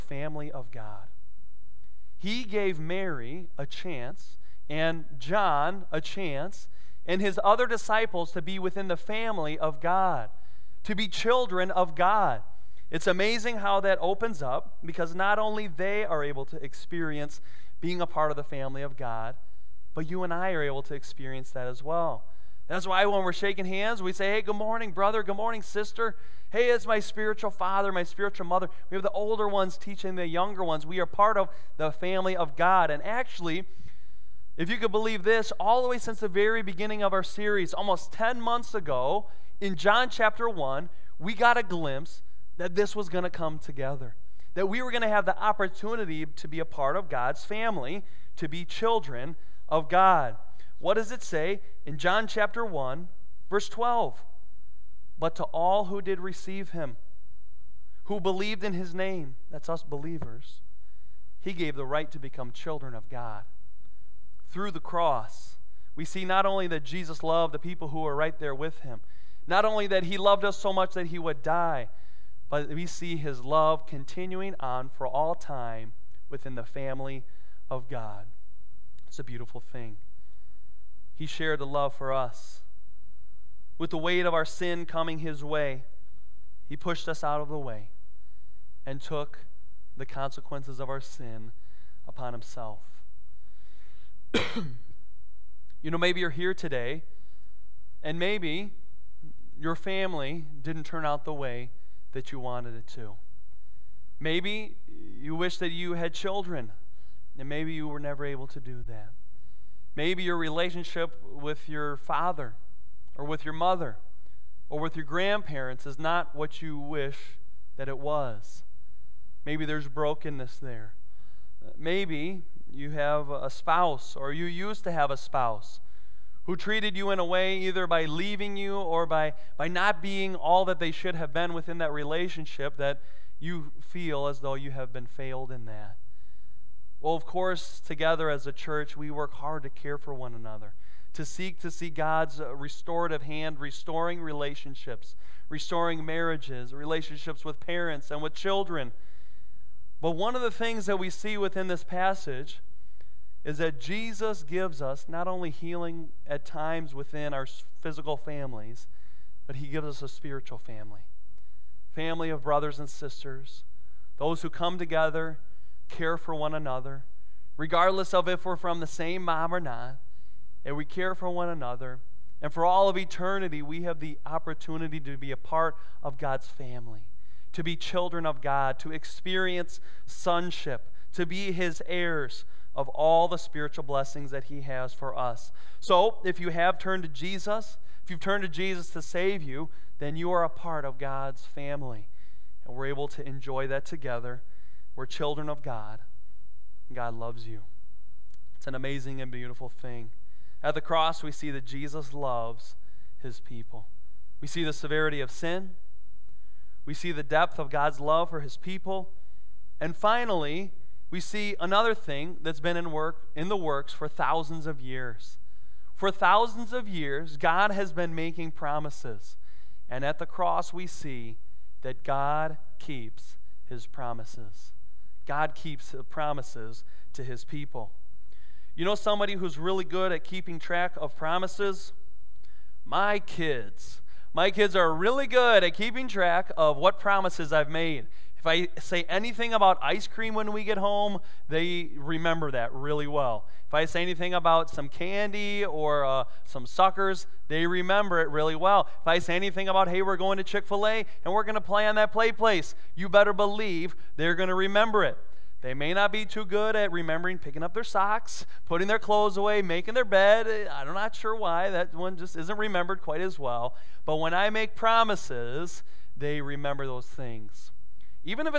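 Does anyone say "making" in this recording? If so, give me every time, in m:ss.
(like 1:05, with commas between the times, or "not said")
3:38, 4:19.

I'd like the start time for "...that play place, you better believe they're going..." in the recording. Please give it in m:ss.
4:11.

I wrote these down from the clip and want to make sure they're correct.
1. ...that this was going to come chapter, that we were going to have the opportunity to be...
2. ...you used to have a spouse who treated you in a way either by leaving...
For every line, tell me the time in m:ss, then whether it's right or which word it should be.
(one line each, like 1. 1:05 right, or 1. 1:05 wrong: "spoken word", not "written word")
1. 0:42 wrong: "together", not "chapter"
2. 2:04 right.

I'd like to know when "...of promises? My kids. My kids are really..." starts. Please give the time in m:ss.
3:50.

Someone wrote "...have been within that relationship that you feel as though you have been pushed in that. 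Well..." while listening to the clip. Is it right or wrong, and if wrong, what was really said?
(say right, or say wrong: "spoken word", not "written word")
wrong: "failed", not "pushed".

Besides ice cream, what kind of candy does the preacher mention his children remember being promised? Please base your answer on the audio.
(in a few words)
suckers.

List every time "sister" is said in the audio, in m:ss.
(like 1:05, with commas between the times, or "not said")
0:25, 2:42.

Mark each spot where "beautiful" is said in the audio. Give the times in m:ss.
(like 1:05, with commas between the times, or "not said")
1:19, 3:19.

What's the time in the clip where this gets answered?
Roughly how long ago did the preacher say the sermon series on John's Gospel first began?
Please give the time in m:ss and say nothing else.
0:37.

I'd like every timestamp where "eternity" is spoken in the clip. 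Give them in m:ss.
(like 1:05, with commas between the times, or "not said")
2:52.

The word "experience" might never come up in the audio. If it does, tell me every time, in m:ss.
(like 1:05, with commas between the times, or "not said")
0:16, 0:20, 2:58.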